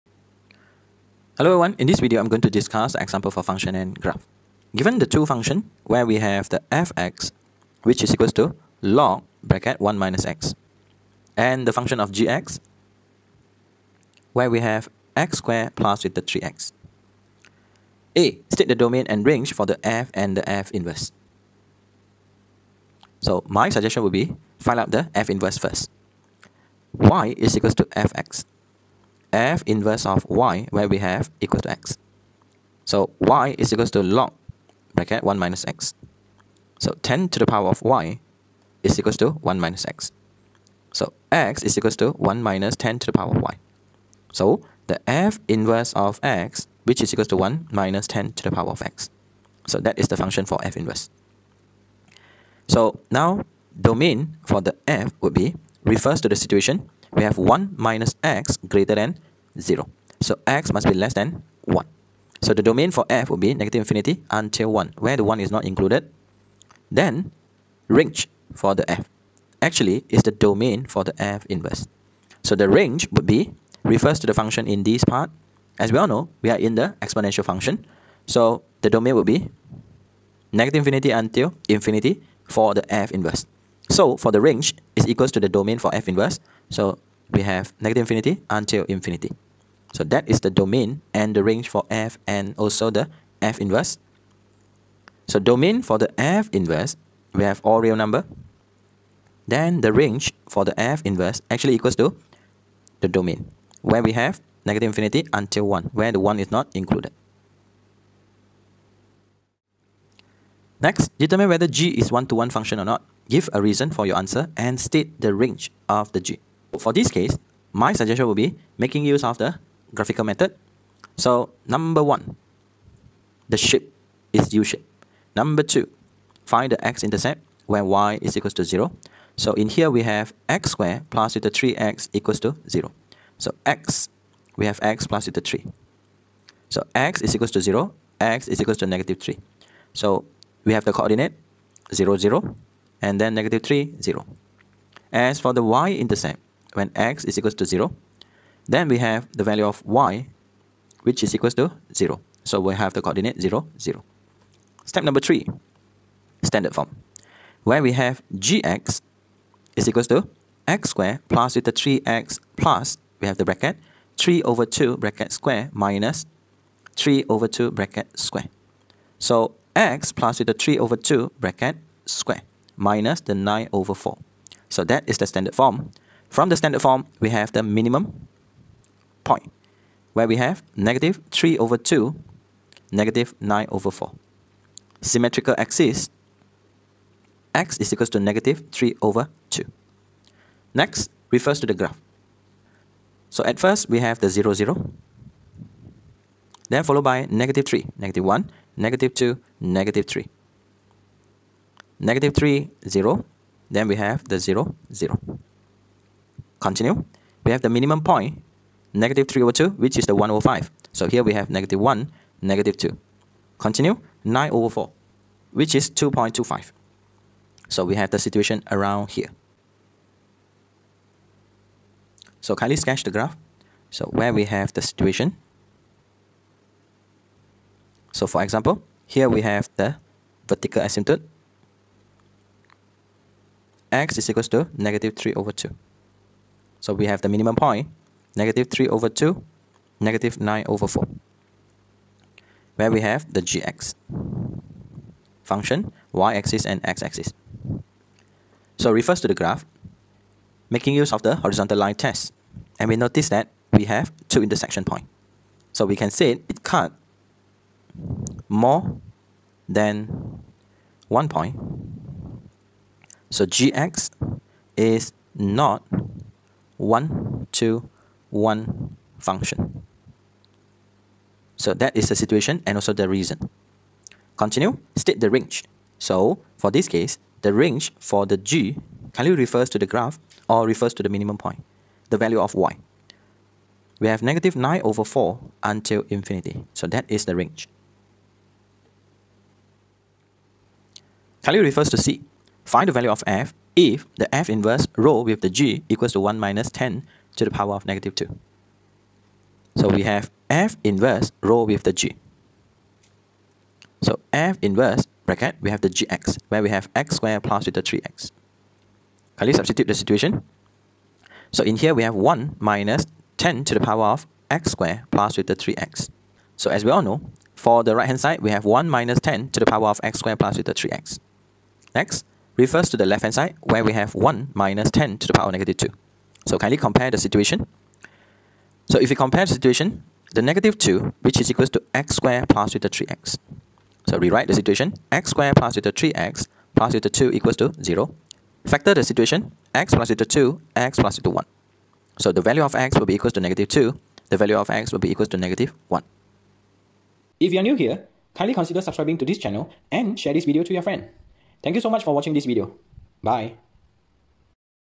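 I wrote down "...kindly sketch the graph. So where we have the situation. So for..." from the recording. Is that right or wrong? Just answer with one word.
right.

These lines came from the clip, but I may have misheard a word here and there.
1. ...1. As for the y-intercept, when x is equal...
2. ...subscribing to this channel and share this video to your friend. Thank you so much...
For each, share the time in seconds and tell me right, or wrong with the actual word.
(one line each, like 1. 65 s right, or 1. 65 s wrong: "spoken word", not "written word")
1. 144 s wrong: "0", not "1"
2. 348 s right.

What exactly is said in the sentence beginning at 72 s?
So the range would be, refers to the function in this part.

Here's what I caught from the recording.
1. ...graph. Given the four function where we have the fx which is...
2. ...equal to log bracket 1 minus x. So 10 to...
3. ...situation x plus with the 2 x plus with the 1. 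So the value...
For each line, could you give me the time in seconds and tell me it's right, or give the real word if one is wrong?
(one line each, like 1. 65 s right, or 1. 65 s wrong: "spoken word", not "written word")
1. 3 s wrong: "two", not "four"
2. 33 s right
3. 339 s right.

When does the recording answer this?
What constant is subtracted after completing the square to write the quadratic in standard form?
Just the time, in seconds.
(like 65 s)
173 s.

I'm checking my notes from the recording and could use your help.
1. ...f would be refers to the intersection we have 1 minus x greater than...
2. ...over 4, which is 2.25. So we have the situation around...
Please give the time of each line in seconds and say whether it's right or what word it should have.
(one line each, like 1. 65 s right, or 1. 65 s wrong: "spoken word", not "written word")
1. 54 s wrong: "situation", not "intersection"
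2. 214 s right.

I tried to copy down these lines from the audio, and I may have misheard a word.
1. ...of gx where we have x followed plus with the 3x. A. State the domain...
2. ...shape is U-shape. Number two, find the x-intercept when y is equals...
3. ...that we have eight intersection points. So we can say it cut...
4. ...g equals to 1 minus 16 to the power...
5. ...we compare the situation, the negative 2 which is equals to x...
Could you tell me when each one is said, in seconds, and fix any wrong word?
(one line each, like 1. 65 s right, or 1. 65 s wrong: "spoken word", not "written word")
1. 11 s wrong: "squared", not "followed"
2. 123 s right
3. 253 s wrong: "two", not "eight"
4. 295 s wrong: "10", not "16"
5. 329 s right.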